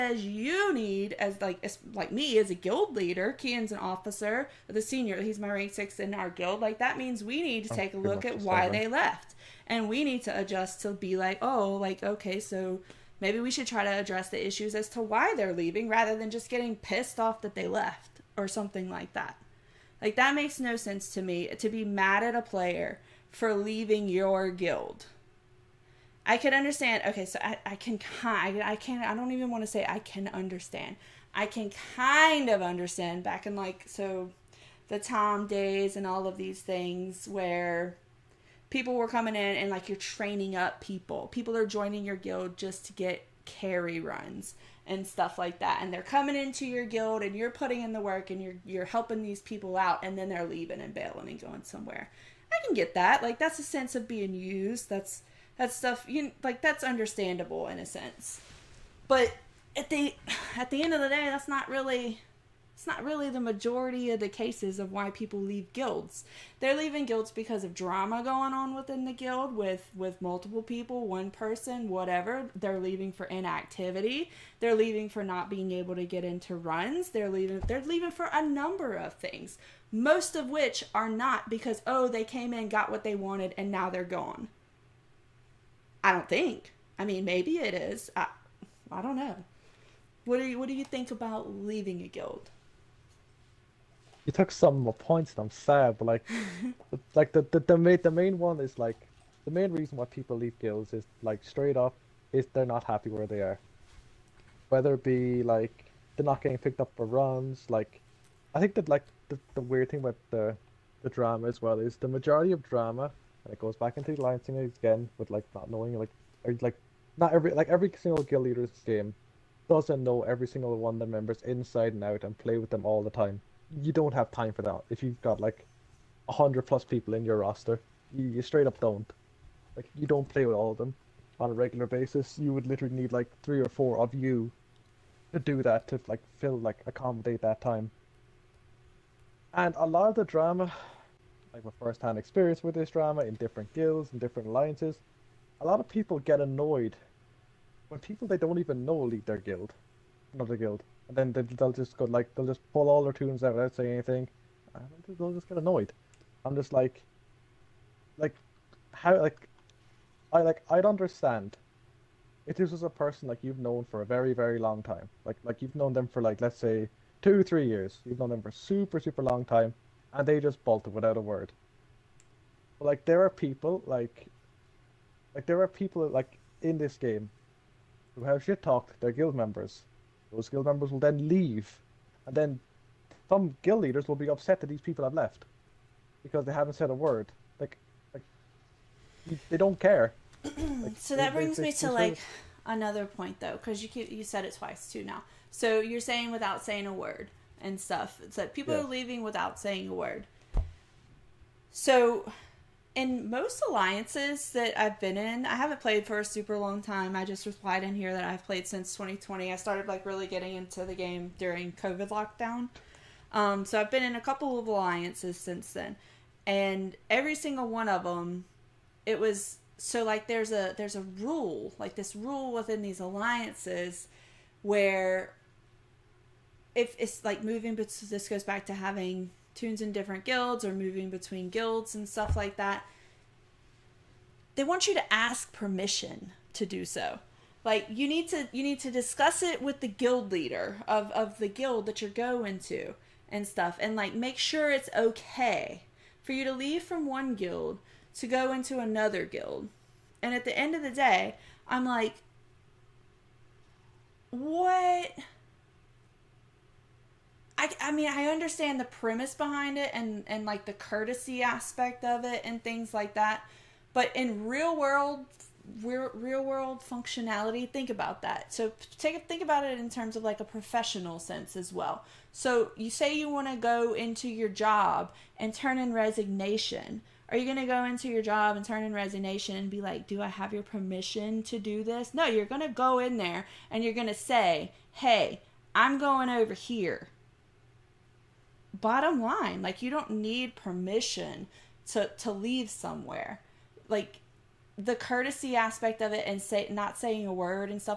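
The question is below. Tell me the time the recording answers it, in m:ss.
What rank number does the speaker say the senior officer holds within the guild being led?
0:05.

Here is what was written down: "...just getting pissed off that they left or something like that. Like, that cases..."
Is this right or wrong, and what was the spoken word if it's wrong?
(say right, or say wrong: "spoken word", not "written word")
wrong: "makes", not "cases".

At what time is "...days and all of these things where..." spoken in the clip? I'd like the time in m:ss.
0:35.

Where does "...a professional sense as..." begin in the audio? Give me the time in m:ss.
4:30.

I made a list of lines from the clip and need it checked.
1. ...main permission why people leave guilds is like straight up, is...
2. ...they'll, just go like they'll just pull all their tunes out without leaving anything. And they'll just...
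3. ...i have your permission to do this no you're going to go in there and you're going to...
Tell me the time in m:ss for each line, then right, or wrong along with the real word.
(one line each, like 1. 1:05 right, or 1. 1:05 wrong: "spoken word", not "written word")
1. 1:39 wrong: "reason", not "permission"
2. 2:31 wrong: "saying", not "leaving"
3. 4:40 right.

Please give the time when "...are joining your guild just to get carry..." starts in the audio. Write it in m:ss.
0:41.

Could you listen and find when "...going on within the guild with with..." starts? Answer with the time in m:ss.
1:08.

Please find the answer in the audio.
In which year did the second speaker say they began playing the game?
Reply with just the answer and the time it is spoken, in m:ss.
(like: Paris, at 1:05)
2020, at 3:28.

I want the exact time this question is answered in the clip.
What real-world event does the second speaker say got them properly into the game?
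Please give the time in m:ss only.
3:31.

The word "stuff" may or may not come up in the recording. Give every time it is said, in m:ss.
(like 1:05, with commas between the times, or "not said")
0:45, 0:55, 3:17, 3:52, 4:03.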